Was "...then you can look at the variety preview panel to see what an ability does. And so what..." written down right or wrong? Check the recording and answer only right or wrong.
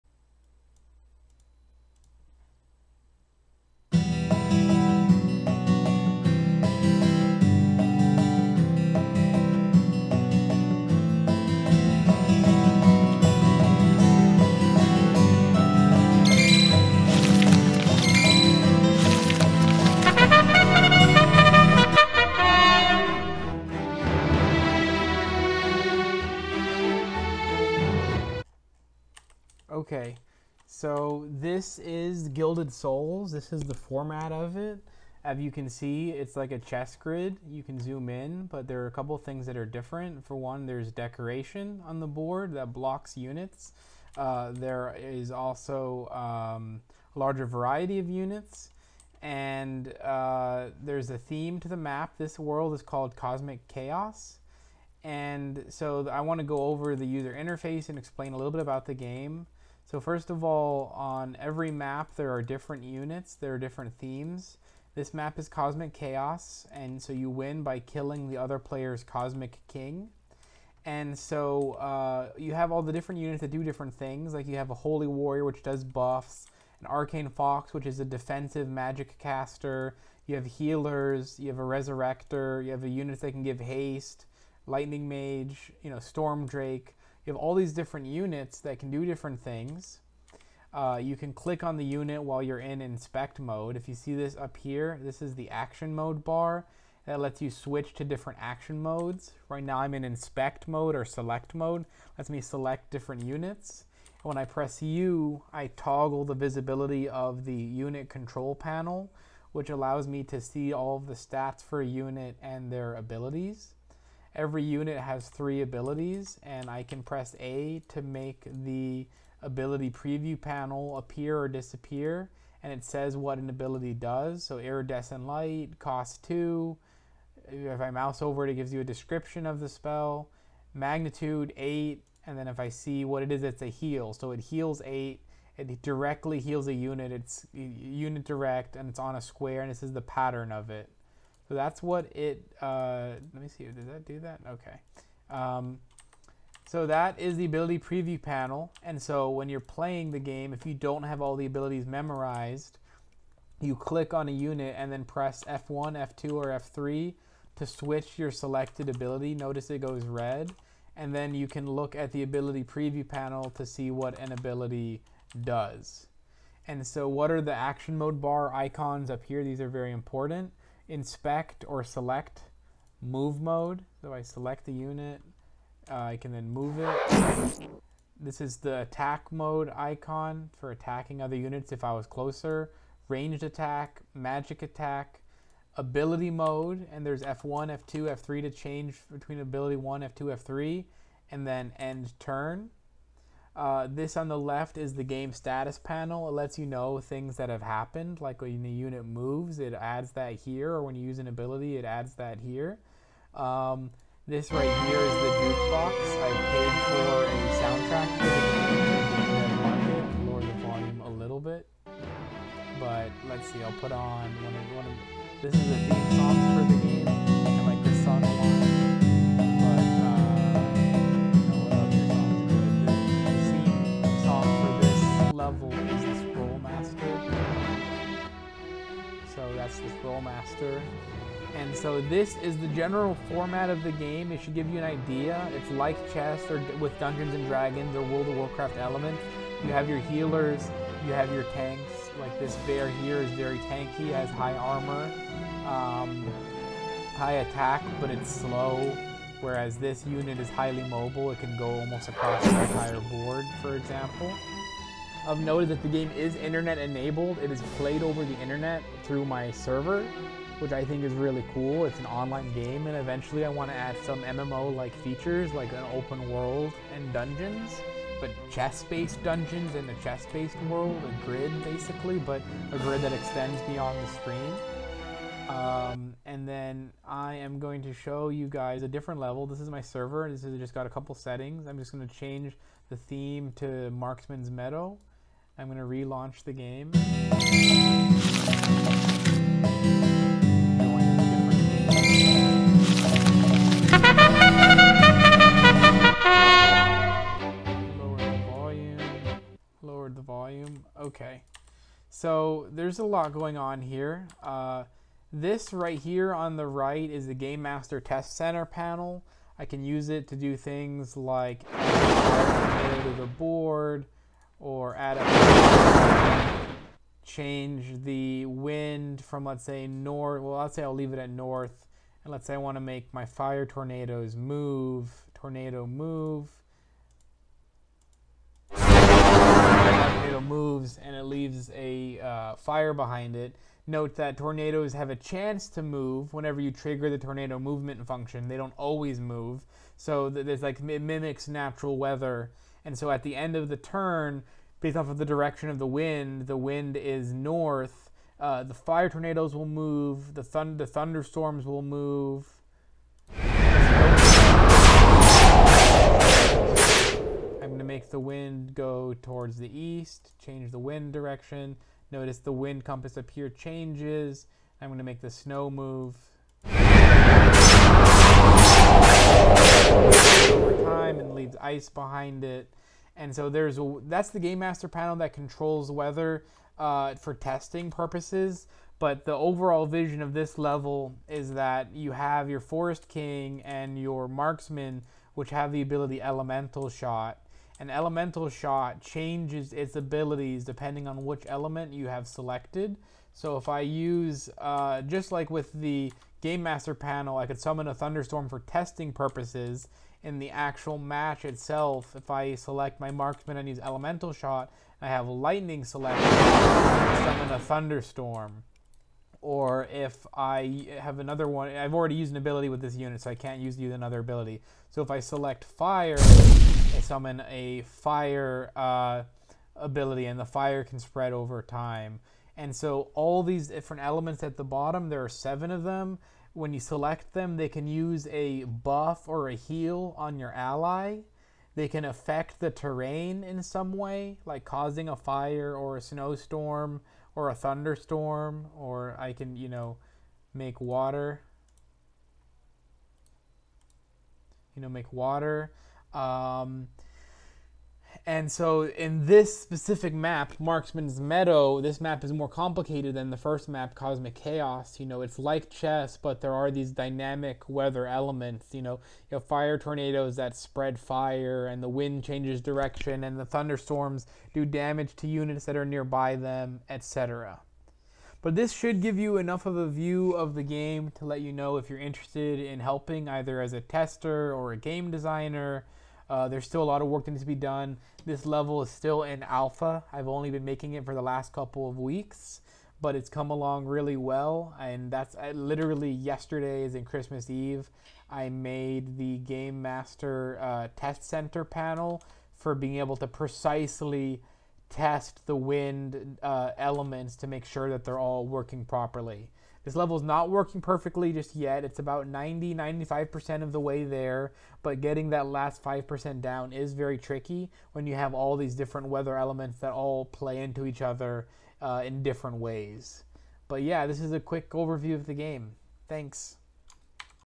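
wrong.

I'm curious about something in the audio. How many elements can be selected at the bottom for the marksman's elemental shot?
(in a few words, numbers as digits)
7.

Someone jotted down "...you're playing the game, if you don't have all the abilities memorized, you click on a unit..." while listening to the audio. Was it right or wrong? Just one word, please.
right.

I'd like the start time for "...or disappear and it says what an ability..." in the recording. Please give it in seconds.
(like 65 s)
121 s.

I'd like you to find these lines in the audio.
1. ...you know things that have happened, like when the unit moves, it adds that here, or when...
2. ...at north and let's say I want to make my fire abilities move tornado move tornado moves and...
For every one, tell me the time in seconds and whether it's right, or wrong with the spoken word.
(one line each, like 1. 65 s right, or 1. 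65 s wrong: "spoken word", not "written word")
1. 196 s right
2. 321 s wrong: "tornadoes", not "abilities".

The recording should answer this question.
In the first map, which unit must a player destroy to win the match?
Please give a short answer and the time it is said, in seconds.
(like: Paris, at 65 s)
Cosmic King, at 69 s.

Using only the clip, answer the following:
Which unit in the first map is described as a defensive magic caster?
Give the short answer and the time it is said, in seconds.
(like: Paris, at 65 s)
Arcane Fox, at 76 s.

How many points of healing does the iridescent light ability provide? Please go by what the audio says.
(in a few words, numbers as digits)
8.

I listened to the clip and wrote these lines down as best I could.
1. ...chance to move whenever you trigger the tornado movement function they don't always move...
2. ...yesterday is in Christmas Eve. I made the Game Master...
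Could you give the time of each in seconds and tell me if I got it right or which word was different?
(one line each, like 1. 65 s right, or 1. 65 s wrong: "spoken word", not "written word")
1. 335 s right
2. 486 s right.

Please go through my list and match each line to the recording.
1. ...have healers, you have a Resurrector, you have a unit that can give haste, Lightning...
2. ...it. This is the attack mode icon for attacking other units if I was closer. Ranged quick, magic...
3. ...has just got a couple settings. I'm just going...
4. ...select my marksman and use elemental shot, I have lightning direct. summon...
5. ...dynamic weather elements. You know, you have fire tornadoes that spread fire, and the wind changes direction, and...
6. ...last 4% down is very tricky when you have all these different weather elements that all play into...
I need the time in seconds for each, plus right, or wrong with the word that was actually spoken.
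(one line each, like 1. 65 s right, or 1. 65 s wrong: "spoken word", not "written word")
1. 80 s right
2. 176 s wrong: "attack", not "quick"
3. 280 s right
4. 402 s wrong: "select", not "direct"
5. 456 s right
6. 505 s wrong: "5", not "4".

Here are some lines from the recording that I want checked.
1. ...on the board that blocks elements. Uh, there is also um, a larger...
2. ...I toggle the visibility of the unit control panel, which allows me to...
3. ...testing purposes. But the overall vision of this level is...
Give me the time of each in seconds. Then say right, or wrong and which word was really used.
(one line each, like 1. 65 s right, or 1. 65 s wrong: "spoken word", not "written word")
1. 41 s wrong: "units", not "elements"
2. 105 s right
3. 377 s right.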